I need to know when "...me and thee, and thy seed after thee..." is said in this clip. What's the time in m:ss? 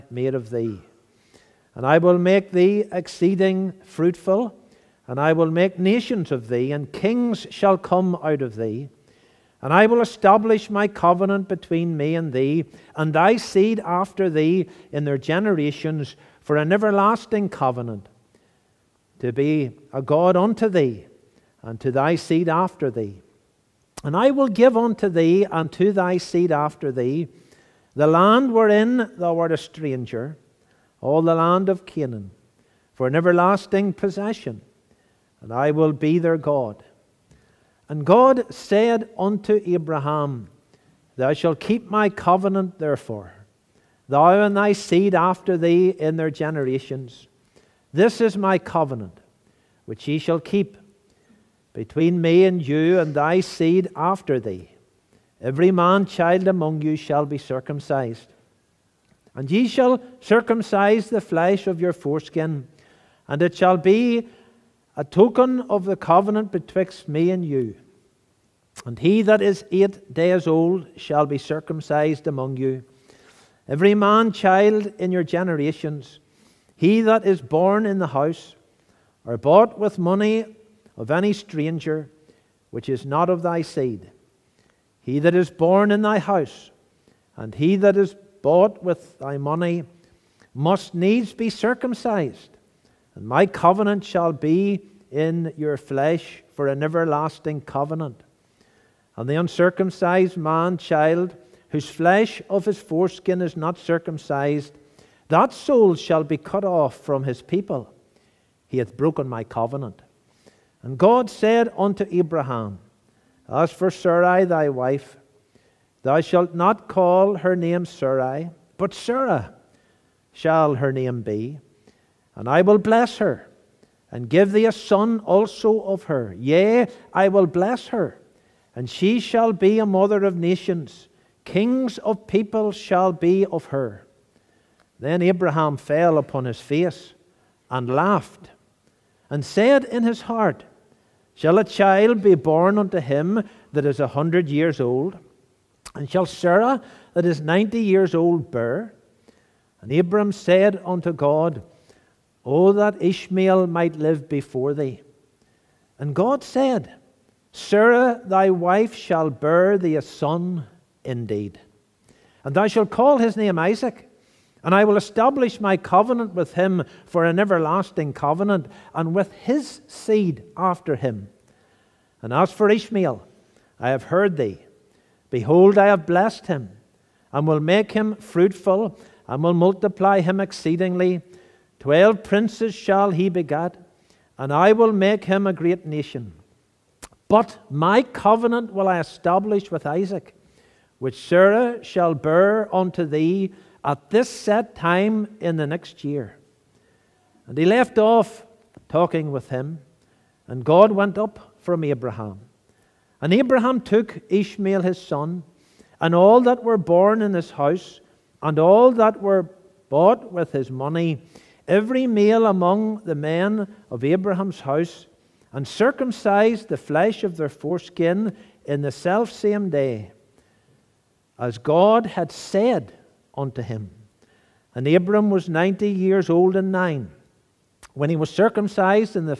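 0:11.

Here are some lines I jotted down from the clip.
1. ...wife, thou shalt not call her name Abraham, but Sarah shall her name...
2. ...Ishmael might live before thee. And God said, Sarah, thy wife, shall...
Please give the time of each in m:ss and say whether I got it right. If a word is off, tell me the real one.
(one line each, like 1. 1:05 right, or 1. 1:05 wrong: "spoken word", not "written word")
1. 1:54 wrong: "Sarai", not "Abraham"
2. 2:32 right.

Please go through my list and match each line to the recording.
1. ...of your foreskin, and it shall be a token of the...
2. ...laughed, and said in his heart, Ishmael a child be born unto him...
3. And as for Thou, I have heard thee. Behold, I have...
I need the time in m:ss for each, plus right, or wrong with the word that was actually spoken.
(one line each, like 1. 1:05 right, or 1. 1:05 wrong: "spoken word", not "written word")
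1. 1:01 right
2. 2:17 wrong: "Shall", not "Ishmael"
3. 2:52 wrong: "Ishmael", not "Thou".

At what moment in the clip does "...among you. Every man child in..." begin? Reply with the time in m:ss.
1:12.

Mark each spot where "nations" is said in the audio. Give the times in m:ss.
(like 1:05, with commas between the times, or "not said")
0:05, 2:10, 3:05.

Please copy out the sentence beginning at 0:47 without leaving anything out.
This is my covenant, which ye shall keep between me and you and thy seed after thee.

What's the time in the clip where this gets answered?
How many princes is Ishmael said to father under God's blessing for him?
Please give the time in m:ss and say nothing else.
3:01.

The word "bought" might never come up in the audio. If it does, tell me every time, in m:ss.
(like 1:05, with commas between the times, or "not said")
1:19, 1:28, 3:29.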